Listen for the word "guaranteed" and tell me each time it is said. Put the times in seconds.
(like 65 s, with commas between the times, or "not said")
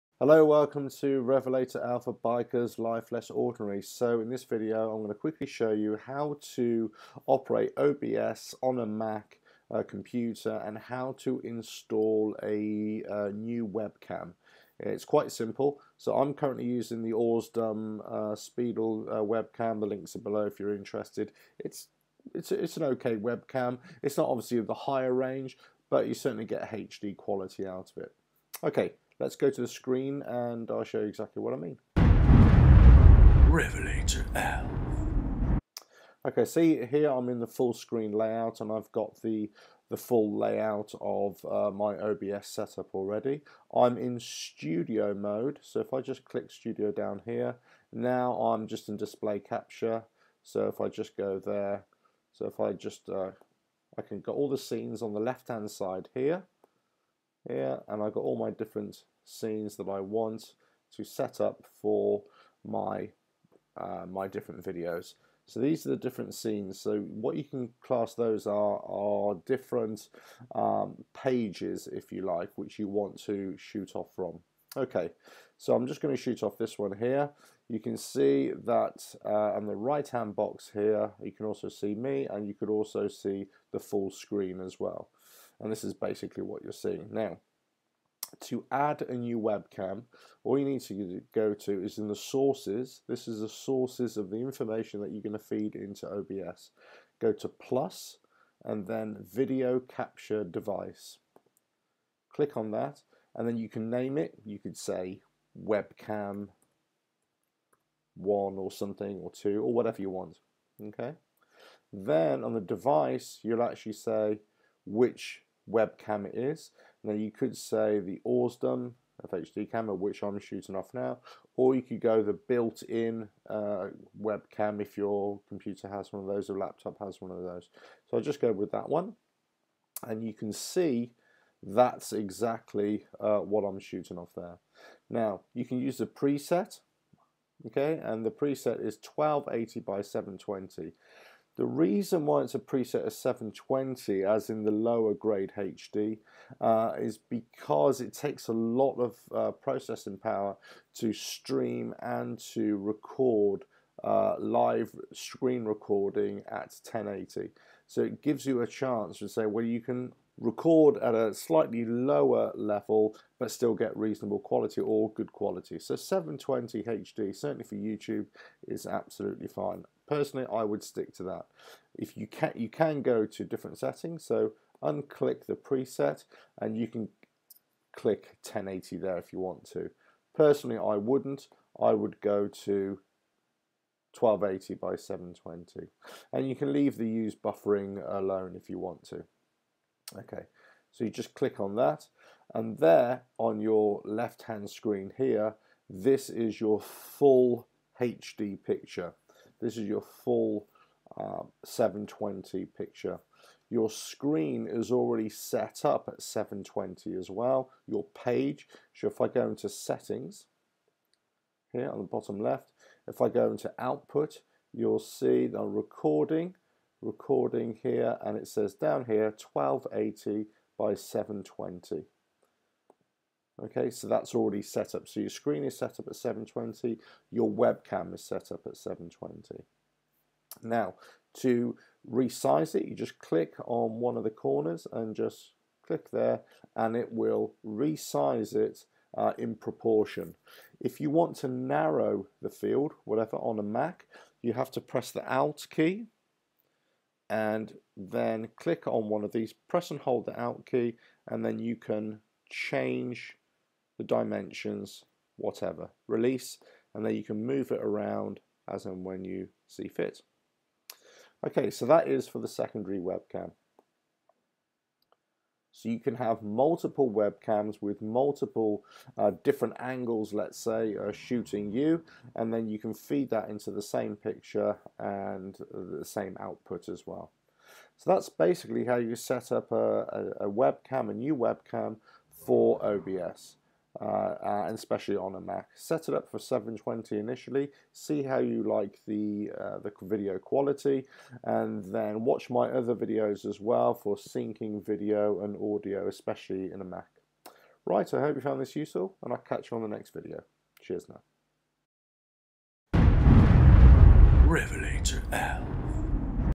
not said.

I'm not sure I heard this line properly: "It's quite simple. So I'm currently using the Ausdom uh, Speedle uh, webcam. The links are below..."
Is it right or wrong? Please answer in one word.
right.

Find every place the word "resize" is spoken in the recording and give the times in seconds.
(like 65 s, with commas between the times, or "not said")
232 s, 237 s.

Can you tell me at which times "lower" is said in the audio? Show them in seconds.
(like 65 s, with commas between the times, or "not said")
144 s, 161 s.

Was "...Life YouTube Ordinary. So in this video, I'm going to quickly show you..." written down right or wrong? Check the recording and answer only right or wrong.
wrong.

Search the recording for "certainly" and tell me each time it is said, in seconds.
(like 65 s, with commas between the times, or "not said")
26 s, 167 s.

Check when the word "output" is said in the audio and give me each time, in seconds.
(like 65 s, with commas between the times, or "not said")
213 s, 276 s.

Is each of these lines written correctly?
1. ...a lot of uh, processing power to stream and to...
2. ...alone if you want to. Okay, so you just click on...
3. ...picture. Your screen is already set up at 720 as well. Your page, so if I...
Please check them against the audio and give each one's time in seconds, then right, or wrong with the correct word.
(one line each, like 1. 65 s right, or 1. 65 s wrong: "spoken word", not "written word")
1. 148 s right
2. 188 s right
3. 202 s right.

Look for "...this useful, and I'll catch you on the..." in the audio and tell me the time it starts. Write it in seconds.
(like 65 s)
298 s.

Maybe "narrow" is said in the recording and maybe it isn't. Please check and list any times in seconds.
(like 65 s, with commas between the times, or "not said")
241 s.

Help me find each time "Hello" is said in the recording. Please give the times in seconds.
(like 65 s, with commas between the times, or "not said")
0 s.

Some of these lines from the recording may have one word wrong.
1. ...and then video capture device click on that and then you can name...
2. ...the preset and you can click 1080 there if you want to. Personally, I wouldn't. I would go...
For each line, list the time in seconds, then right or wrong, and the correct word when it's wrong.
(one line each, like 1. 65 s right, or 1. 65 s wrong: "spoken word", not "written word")
1. 98 s right
2. 175 s right.